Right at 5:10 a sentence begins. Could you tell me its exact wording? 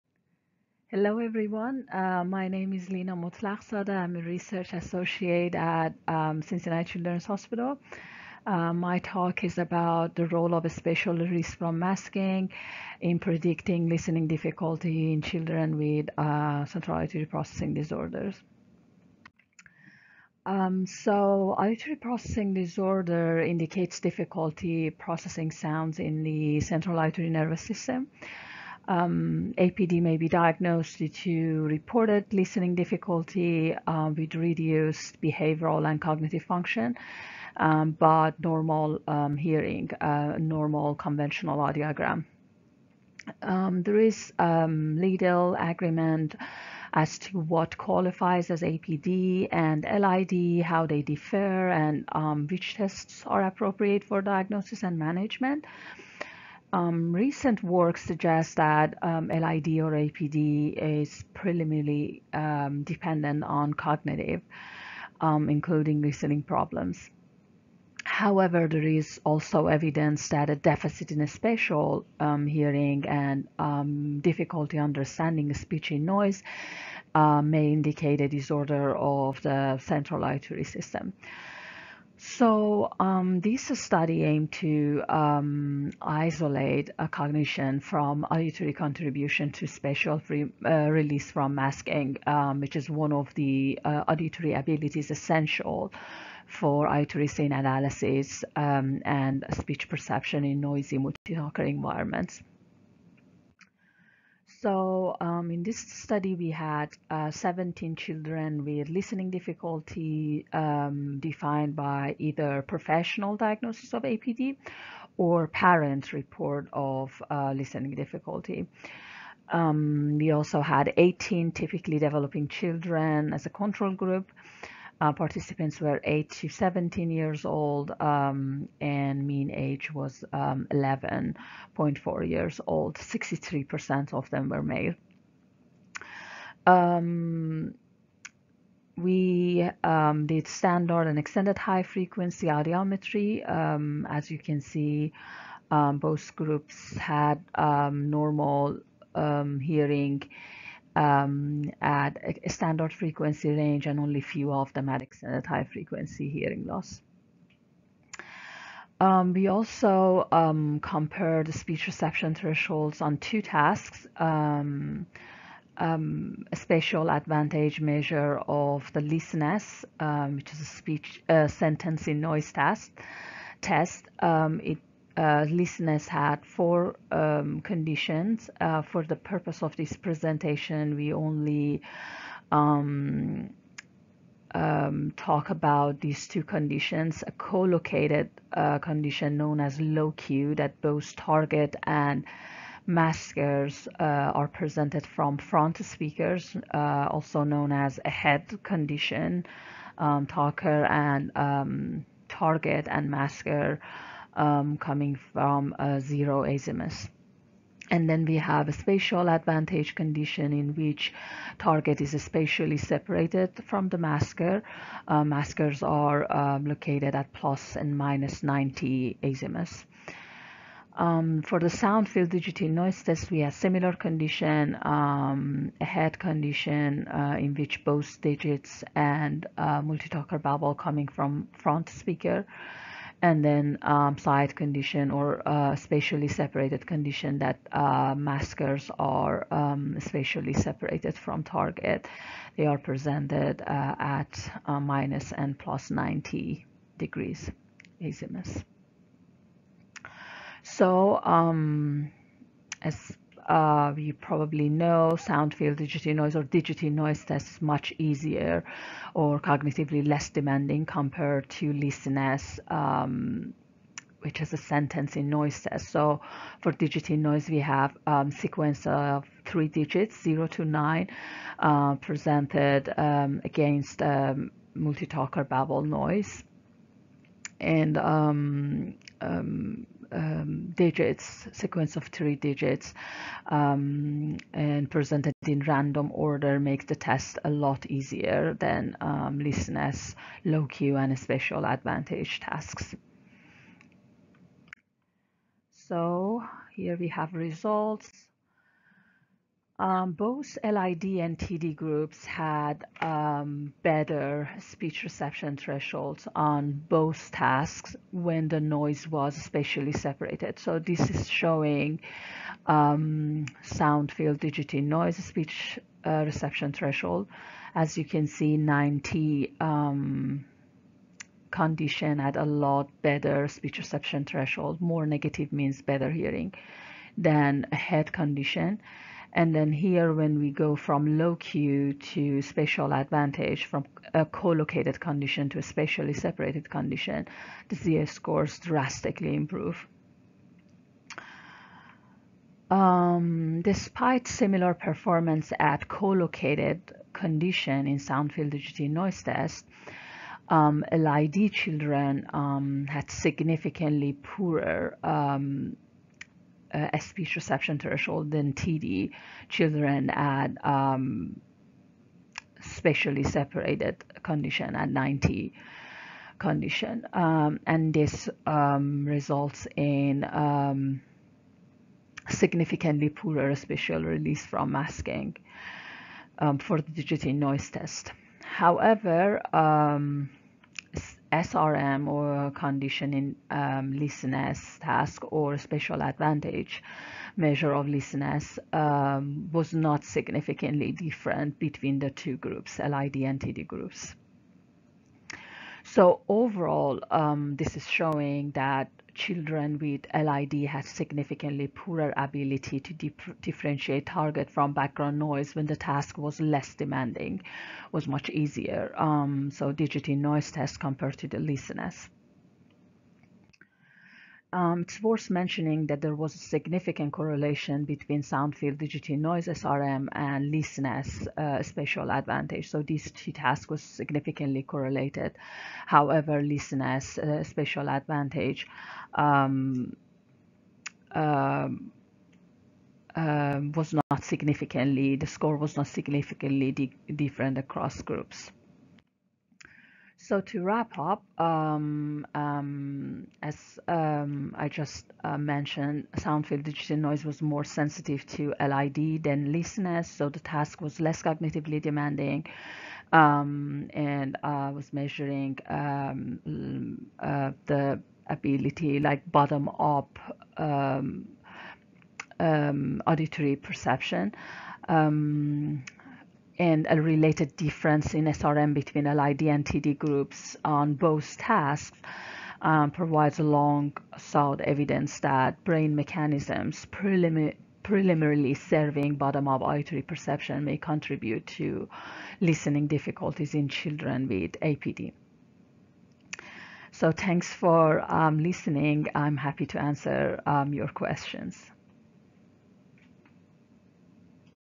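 So this is showing um, sound field digity noise speech uh, reception threshold.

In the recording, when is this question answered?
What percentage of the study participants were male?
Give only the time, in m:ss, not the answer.
2:12.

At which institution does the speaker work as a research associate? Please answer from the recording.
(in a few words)
Cincinnati Children's Hospital.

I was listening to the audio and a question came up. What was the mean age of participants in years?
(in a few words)
11.4.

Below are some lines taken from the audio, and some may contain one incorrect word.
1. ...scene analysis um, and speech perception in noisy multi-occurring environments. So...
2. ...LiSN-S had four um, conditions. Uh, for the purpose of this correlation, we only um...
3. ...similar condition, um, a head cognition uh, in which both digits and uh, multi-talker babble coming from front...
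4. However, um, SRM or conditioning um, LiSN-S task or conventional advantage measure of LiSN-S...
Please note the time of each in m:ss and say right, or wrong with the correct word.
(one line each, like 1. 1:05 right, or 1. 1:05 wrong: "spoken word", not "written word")
1. 1:37 right
2. 2:55 wrong: "presentation", not "correlation"
3. 3:43 wrong: "condition", not "cognition"
4. 6:18 wrong: "spatial", not "conventional".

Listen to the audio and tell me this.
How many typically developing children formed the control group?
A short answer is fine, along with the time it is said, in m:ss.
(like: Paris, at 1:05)
18, at 2:00.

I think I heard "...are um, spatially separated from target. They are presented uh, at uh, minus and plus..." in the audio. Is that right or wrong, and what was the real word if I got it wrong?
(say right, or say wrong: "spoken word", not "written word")
right.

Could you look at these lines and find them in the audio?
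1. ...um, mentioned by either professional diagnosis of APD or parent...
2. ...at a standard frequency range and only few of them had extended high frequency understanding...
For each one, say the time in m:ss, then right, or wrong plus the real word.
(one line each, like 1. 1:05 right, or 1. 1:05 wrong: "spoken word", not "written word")
1. 1:50 wrong: "defined", not "mentioned"
2. 2:31 wrong: "hearing", not "understanding".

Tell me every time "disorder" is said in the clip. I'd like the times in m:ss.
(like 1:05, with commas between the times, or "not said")
0:17, 0:22, 1:18.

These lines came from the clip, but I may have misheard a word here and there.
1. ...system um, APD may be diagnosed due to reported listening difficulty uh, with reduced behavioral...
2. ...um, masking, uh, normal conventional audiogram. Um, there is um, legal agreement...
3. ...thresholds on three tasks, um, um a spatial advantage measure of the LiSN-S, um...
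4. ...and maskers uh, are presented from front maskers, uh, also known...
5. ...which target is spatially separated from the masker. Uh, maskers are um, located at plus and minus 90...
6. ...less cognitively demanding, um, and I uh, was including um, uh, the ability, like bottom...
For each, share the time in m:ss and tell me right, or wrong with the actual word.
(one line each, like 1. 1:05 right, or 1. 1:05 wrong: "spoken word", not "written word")
1. 0:27 right
2. 0:39 wrong: "hearing", not "masking"
3. 2:42 wrong: "two", not "three"
4. 3:11 wrong: "speakers", not "maskers"
5. 3:30 right
6. 7:31 wrong: "measuring", not "including".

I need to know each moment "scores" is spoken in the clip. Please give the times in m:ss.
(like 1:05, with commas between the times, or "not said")
5:38, 7:15.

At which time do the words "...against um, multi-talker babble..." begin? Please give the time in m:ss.
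4:33.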